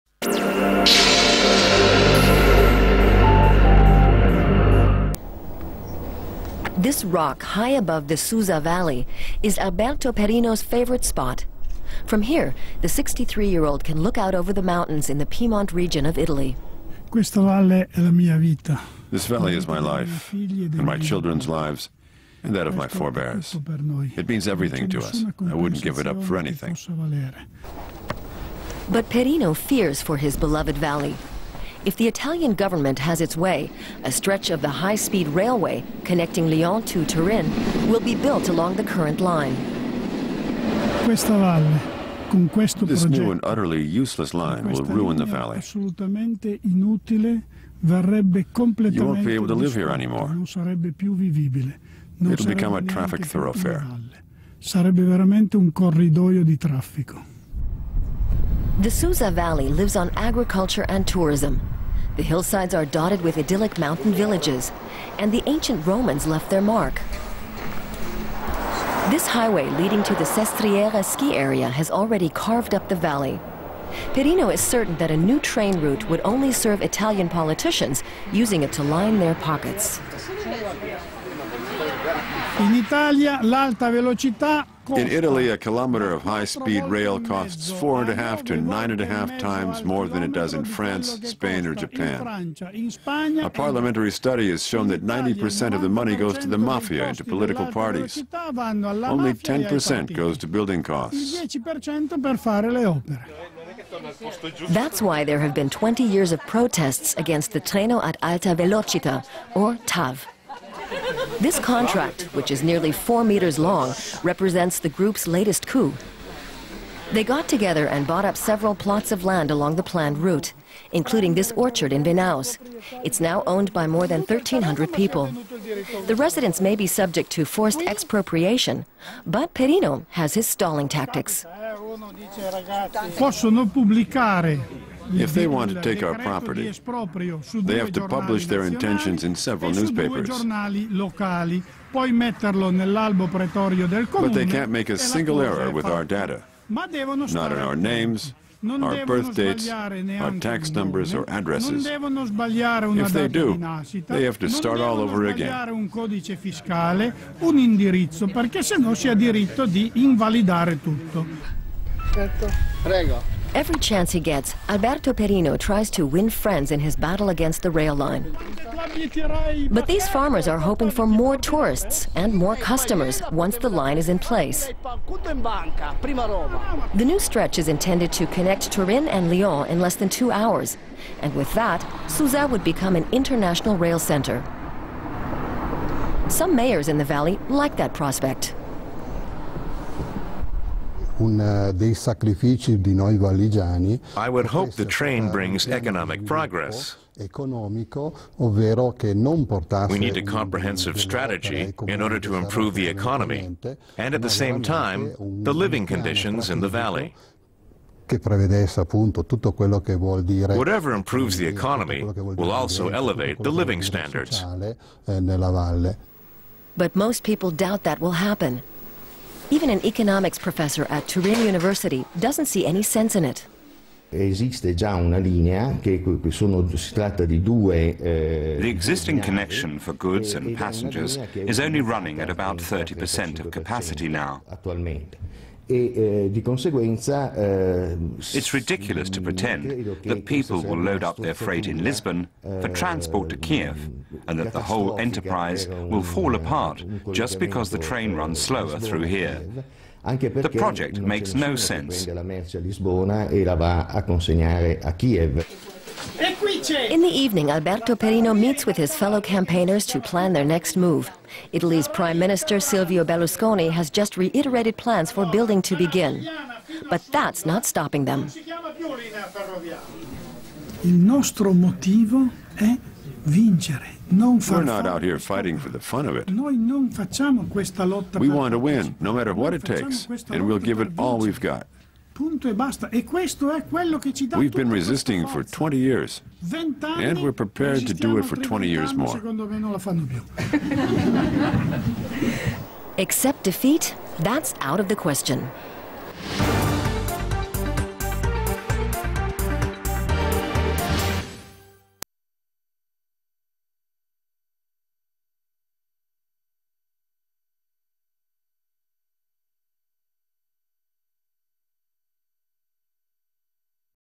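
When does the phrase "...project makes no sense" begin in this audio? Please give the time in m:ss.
4:10.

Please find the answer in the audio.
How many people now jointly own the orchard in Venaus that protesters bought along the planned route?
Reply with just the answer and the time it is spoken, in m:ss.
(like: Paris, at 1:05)
more than 1,300, at 2:03.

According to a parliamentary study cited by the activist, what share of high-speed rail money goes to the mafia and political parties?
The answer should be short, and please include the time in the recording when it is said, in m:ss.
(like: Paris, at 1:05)
90%, at 1:35.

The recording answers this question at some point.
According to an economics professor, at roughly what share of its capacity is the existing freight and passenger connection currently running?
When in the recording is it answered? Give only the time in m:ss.
3:52.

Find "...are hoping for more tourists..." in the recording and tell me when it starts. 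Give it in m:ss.
2:50.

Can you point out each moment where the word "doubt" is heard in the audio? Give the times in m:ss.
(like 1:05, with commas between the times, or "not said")
3:37.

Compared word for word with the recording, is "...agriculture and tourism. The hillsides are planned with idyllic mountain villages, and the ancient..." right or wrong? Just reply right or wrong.
wrong.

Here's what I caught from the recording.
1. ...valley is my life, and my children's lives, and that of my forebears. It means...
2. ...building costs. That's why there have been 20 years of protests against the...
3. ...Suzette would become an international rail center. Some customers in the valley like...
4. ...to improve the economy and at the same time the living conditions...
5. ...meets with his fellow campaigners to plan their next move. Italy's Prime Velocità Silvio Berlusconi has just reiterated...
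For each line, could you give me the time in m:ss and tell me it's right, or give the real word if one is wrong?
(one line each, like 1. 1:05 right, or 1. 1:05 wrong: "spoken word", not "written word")
1. 0:17 right
2. 1:40 right
3. 3:02 wrong: "mayors", not "customers"
4. 3:22 right
5. 4:18 wrong: "Minister", not "Velocità".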